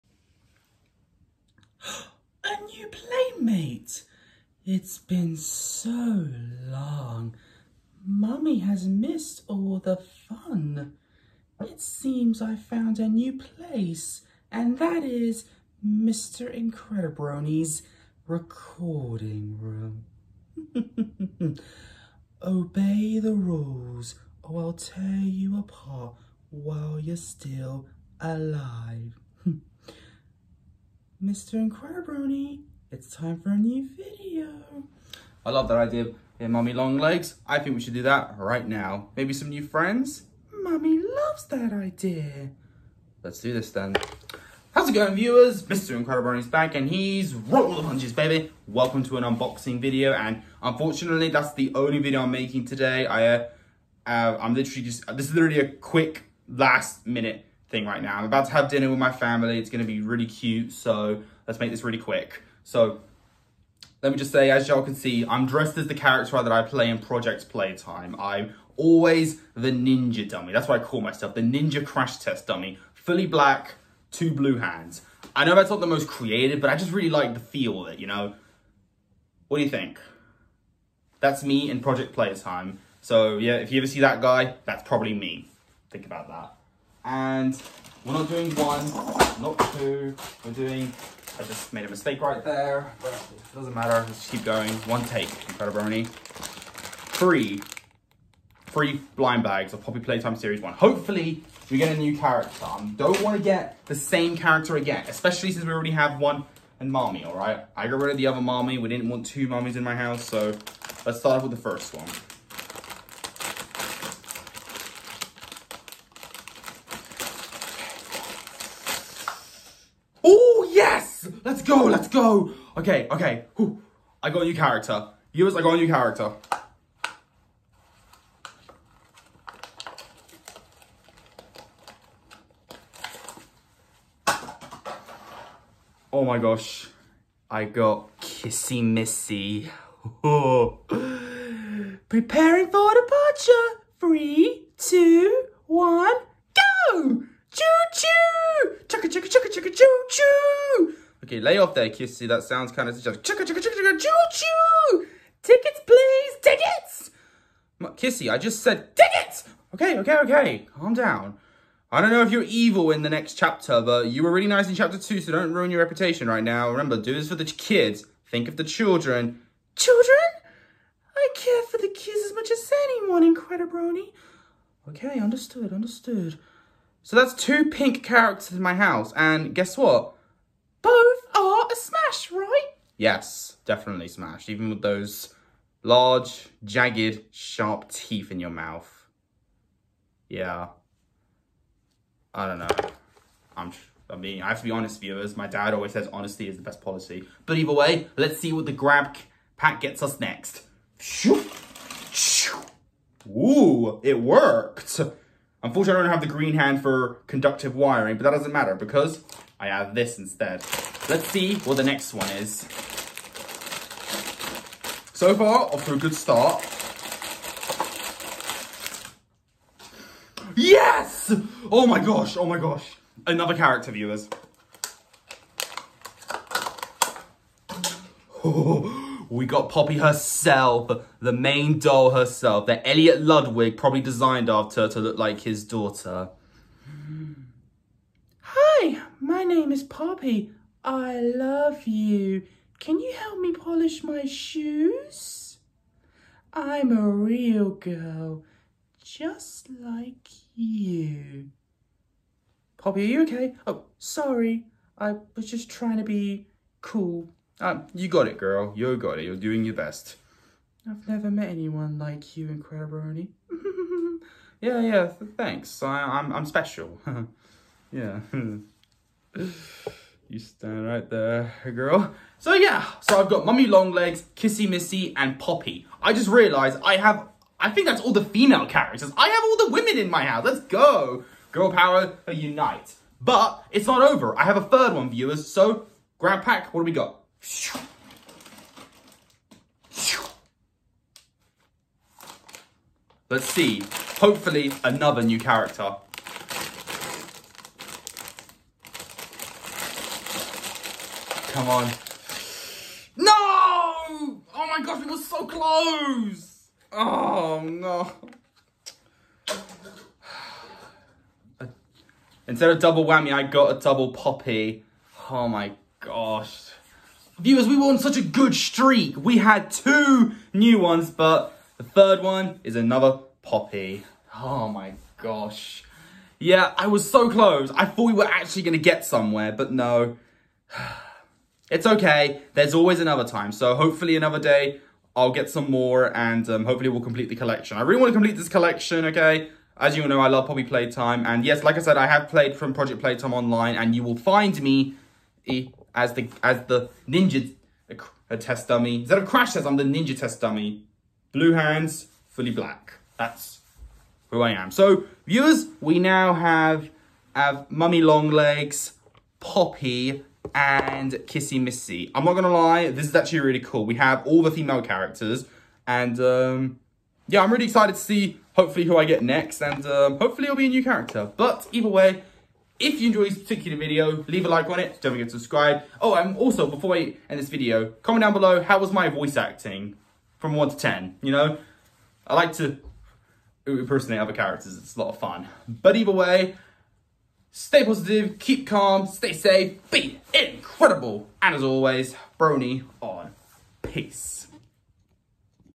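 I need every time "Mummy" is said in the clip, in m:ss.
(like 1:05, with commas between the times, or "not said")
0:08, 0:36, 0:40, 4:33, 5:57.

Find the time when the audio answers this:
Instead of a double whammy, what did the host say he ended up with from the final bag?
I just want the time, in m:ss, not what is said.
5:13.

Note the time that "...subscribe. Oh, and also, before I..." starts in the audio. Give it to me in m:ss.
6:15.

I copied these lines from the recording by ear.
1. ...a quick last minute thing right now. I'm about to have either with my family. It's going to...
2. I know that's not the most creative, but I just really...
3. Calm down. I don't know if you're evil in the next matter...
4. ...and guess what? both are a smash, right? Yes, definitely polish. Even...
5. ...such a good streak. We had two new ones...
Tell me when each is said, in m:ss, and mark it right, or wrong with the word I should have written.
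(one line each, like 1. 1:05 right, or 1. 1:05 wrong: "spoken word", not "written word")
1. 0:55 wrong: "dinner", not "either"
2. 1:15 right
3. 2:40 wrong: "chapter", not "matter"
4. 2:59 wrong: "smash", not "polish"
5. 5:17 right.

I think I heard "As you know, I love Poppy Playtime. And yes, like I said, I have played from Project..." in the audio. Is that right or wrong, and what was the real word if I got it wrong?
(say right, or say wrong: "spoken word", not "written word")
right.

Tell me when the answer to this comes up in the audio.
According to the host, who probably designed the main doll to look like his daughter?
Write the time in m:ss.
3:52.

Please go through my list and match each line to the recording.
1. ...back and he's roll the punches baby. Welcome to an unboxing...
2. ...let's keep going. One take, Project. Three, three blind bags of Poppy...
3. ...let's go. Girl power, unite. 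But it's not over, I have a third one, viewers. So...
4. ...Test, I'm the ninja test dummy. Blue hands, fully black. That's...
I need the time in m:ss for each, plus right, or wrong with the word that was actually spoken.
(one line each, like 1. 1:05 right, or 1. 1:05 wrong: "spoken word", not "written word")
1. 0:46 right
2. 1:34 wrong: "Incredibrony", not "Project"
3. 4:40 right
4. 5:49 right.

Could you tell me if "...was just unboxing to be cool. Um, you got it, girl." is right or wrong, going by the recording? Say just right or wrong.
wrong.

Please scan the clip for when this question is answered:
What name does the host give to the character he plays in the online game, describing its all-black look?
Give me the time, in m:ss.
1:11.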